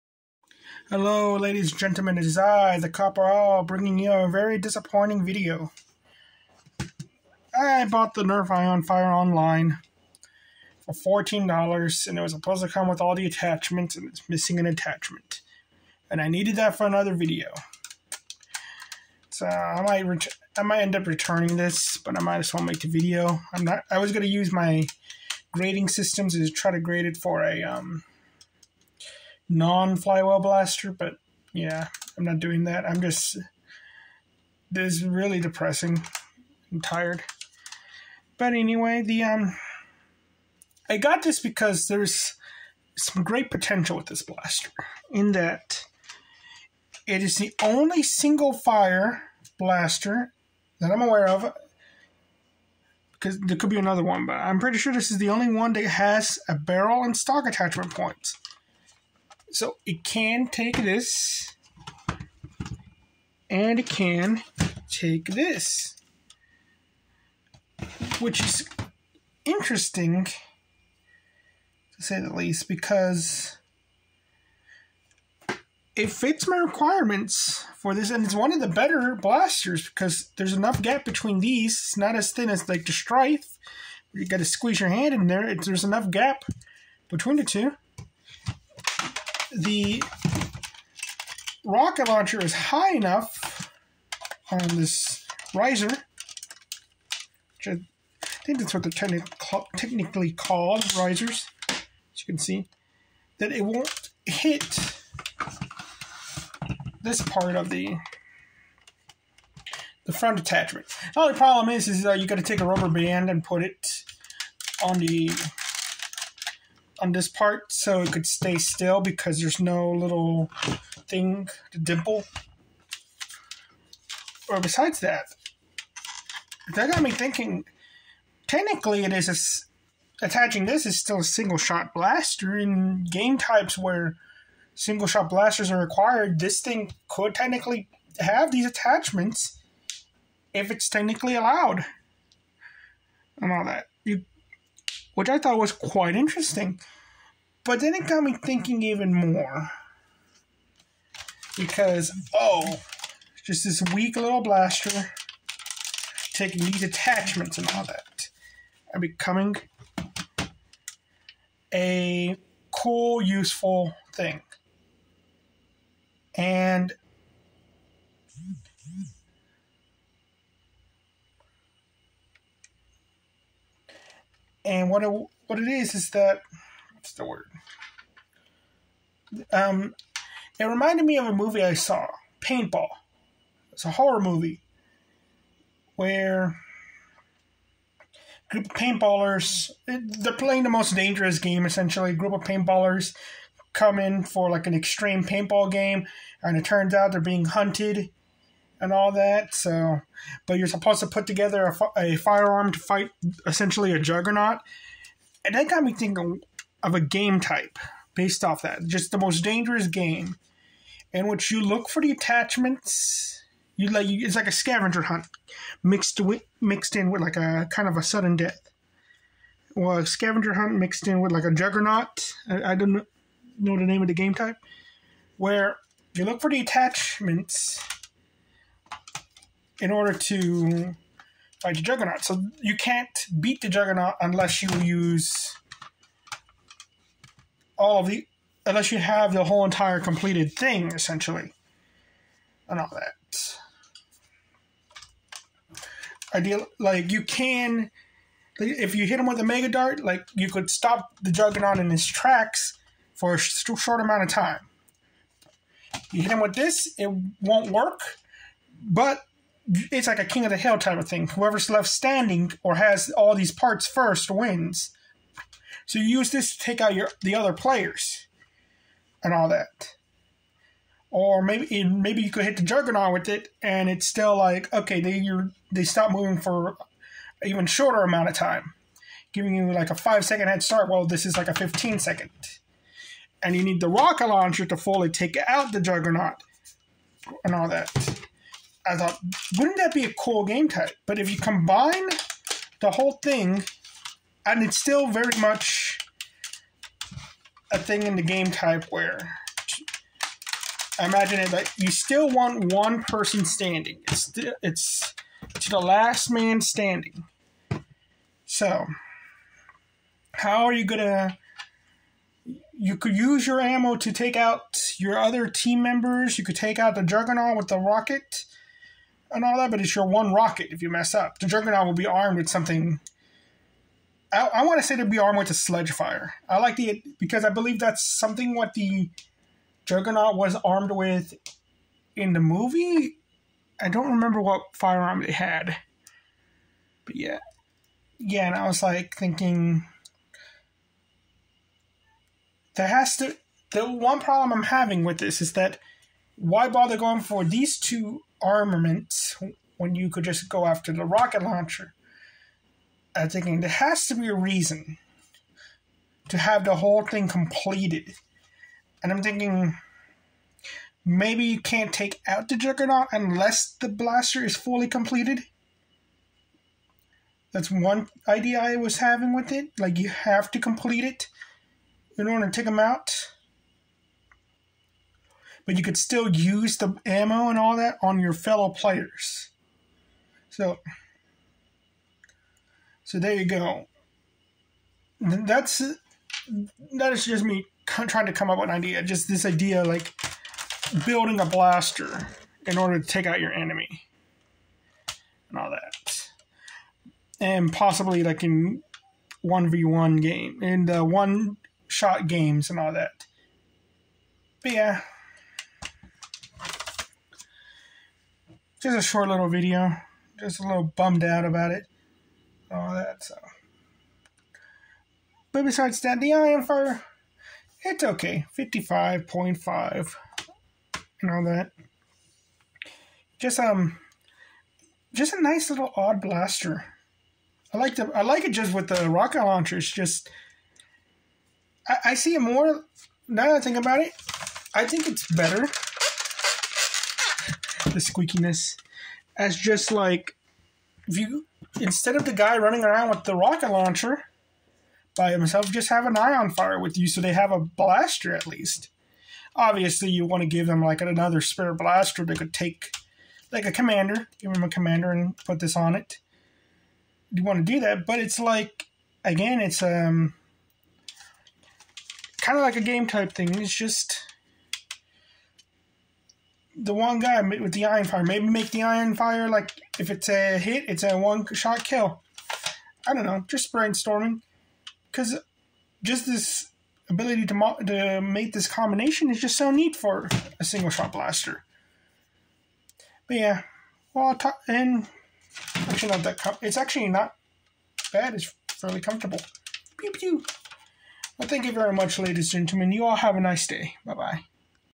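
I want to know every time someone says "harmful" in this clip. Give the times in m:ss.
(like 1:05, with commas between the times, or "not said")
not said.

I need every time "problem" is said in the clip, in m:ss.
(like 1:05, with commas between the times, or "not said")
1:51, 5:44.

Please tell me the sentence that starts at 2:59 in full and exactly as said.
Um, it reminded me of a movie I saw, Paintball.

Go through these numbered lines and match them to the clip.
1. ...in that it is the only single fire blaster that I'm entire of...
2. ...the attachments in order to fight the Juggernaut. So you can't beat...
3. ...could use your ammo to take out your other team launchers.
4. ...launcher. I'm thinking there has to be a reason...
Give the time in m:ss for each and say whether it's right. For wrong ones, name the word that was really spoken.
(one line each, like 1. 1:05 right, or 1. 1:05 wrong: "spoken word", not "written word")
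1. 0:45 wrong: "aware", not "entire"
2. 3:46 right
3. 5:12 wrong: "members", not "launchers"
4. 5:51 right.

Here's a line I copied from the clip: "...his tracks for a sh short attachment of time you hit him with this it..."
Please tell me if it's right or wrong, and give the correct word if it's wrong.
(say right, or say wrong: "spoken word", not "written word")
wrong: "amount", not "attachment".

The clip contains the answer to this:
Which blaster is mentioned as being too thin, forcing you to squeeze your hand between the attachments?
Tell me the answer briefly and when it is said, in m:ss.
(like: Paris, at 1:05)
Stryfe, at 1:22.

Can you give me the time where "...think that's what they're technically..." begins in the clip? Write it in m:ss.
1:38.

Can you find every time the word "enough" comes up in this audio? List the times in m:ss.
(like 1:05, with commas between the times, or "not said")
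1:20, 1:25, 1:32.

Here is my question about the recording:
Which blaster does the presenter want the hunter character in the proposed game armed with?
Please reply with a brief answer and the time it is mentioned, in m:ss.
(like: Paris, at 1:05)
Sledgefire, at 5:25.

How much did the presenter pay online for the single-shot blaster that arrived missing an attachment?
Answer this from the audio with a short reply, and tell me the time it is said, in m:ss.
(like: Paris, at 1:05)
$14, at 0:11.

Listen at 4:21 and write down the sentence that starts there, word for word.
Whoever's left standing or has all these parts first wins.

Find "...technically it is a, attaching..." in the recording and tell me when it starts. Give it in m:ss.
2:08.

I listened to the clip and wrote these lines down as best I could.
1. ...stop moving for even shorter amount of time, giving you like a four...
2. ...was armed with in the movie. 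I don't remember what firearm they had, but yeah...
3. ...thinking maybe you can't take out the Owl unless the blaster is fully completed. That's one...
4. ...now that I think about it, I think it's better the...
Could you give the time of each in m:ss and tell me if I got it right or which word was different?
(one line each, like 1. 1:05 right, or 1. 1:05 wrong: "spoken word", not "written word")
1. 4:35 wrong: "five", not "four"
2. 5:30 right
3. 5:59 wrong: "Juggernaut", not "Owl"
4. 7:13 right.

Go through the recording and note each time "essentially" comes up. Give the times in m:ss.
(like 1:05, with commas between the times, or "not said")
3:11, 3:23, 4:00.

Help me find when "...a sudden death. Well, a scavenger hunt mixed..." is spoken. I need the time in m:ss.
3:37.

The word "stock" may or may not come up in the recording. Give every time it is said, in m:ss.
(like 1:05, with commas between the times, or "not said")
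0:57.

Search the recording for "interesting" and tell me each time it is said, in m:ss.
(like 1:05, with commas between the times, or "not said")
1:09, 2:26.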